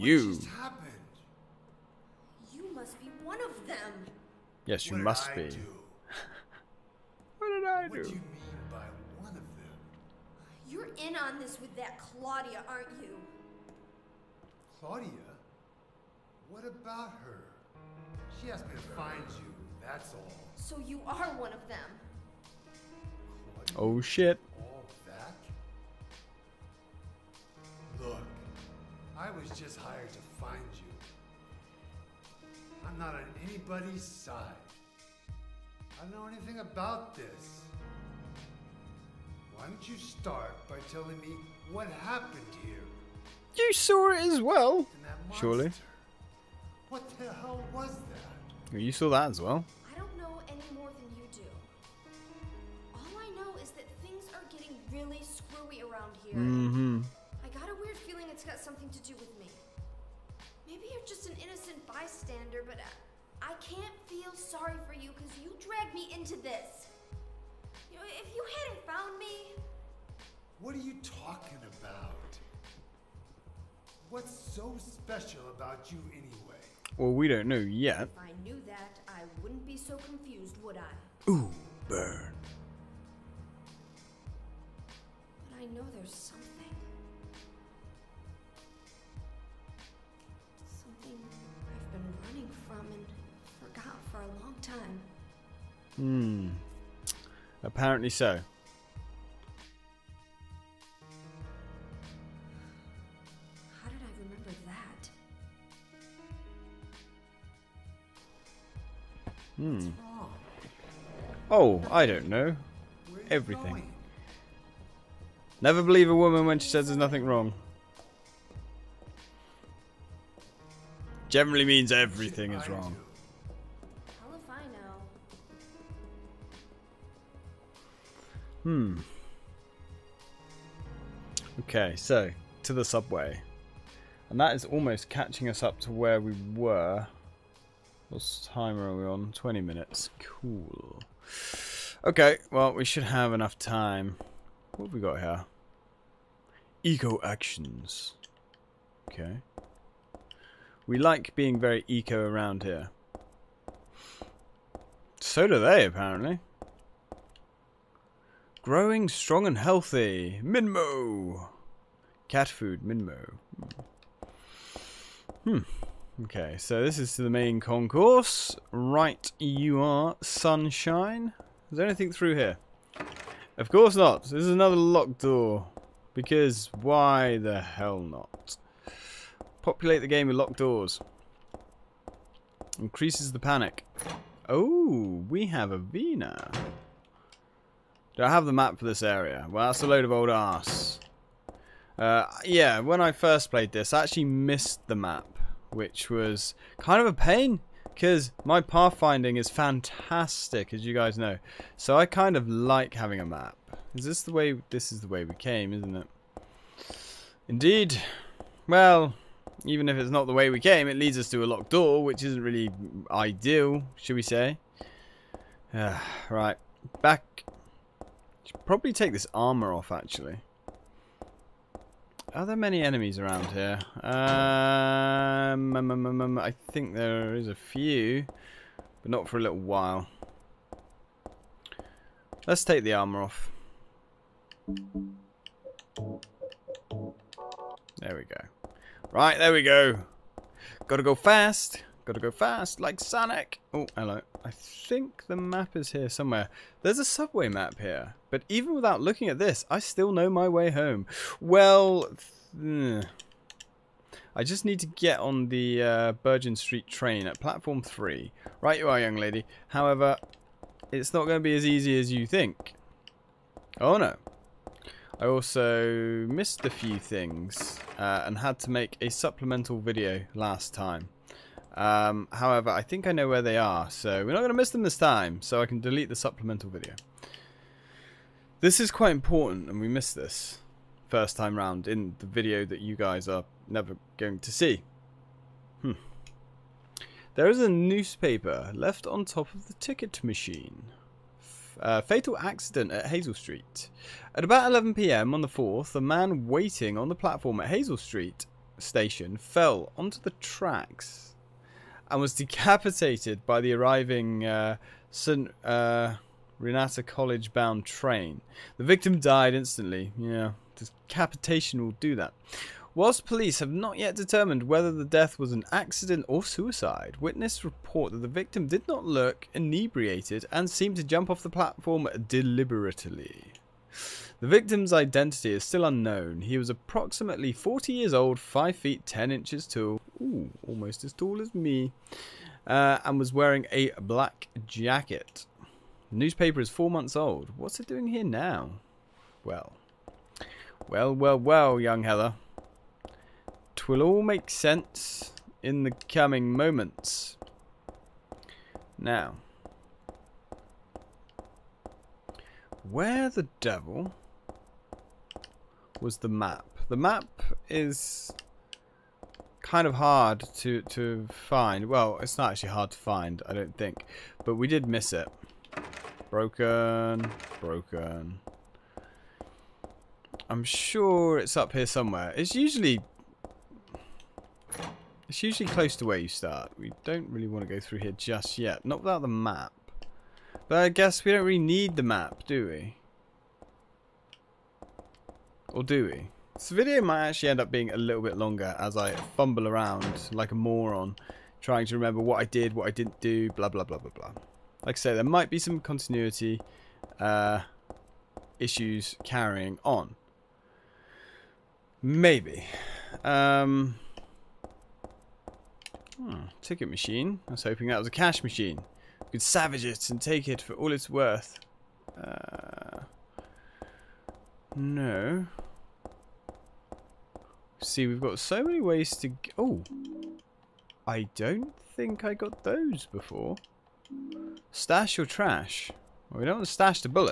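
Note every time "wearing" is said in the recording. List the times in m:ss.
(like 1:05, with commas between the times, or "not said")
5:33.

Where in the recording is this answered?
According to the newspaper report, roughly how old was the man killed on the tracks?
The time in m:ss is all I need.
5:27.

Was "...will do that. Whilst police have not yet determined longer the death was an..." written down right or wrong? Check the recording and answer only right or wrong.
wrong.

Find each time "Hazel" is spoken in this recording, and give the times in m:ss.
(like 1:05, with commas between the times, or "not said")
4:53, 4:57.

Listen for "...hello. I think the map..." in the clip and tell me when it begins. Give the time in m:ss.
4:03.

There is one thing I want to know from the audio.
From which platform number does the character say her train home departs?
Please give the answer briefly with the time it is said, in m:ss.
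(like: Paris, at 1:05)
3, at 4:17.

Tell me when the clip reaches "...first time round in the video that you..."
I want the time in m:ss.
4:41.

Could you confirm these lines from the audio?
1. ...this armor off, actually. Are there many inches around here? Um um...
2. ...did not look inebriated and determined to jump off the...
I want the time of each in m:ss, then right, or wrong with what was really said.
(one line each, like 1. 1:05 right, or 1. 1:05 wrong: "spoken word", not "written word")
1. 3:39 wrong: "enemies", not "inches"
2. 5:18 wrong: "seemed", not "determined".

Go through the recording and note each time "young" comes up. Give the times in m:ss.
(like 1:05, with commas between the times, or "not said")
4:18, 5:41.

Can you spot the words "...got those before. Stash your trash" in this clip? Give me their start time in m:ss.
7:02.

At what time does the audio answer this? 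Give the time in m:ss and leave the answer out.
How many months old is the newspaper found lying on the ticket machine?
5:36.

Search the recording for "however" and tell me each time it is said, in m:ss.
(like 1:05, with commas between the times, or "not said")
4:19, 4:32.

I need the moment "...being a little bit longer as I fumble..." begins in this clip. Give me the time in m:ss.
6:27.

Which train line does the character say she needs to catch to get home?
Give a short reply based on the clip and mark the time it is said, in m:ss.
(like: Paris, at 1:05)
Bergen Street, at 4:16.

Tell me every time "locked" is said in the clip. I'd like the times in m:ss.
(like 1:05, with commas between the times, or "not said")
2:54, 3:00, 3:31.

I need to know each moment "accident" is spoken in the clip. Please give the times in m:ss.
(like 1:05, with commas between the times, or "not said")
4:52, 5:15.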